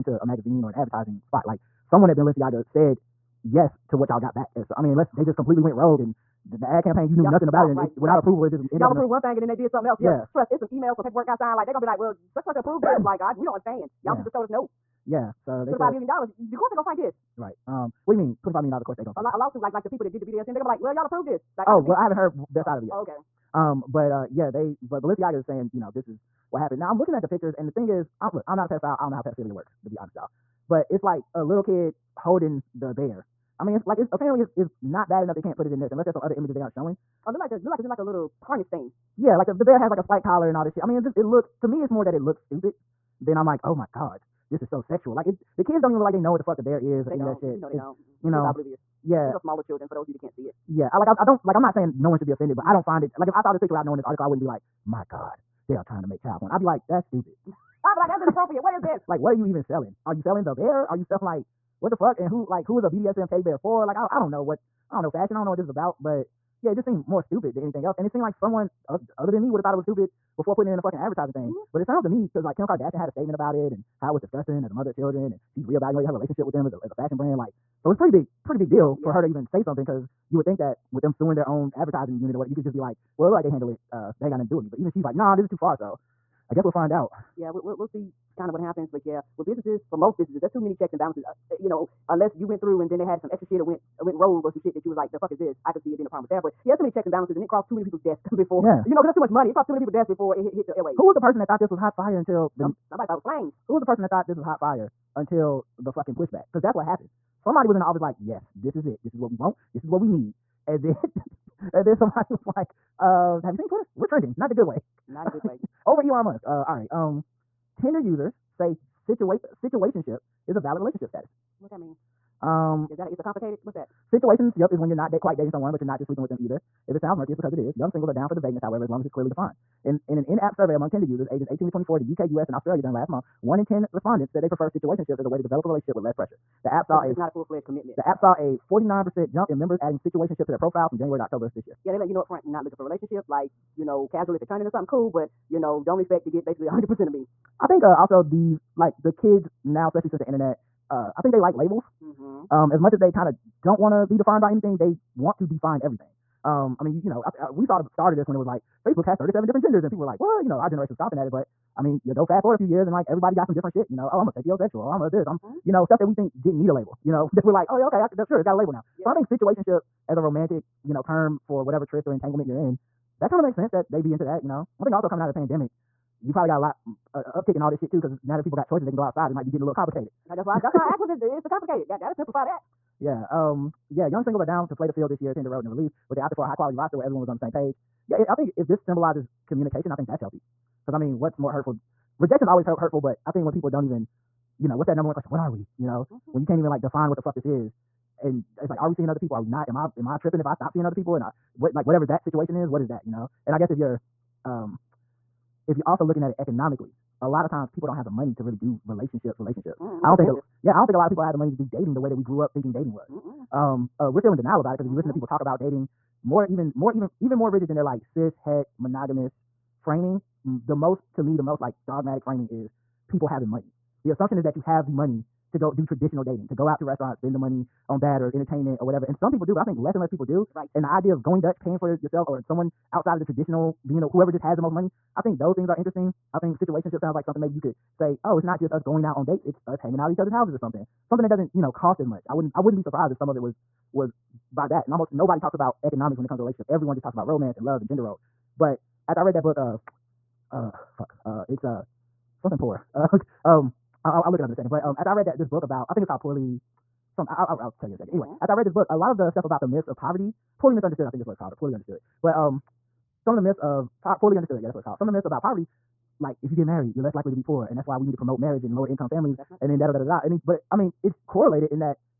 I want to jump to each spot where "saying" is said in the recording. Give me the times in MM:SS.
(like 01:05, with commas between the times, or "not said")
00:25, 00:51.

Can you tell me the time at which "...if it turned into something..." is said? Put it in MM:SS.
02:24.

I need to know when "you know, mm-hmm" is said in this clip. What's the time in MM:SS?
03:15.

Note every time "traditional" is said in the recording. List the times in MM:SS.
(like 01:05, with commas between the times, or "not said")
03:45, 03:53.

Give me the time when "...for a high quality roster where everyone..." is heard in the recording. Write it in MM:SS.
03:06.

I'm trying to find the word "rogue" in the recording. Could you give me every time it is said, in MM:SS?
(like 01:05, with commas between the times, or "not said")
00:05, 01:34.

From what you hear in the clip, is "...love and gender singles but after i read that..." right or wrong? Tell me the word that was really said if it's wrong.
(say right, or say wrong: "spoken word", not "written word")
wrong: "roles", not "singles".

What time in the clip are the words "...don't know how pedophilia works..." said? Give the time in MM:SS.
00:29.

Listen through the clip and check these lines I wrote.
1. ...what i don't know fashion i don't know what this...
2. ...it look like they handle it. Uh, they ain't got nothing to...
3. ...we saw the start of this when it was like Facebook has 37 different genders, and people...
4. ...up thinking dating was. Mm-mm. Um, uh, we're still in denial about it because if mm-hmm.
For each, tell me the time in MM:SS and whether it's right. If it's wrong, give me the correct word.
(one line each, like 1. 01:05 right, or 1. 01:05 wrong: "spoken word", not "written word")
1. 01:04 right
2. 01:23 right
3. 02:37 right
4. 03:32 right.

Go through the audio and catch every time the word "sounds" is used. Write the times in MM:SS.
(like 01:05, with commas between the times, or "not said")
01:11, 02:06, 03:56.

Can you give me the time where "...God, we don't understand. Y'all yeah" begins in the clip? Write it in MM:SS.
00:13.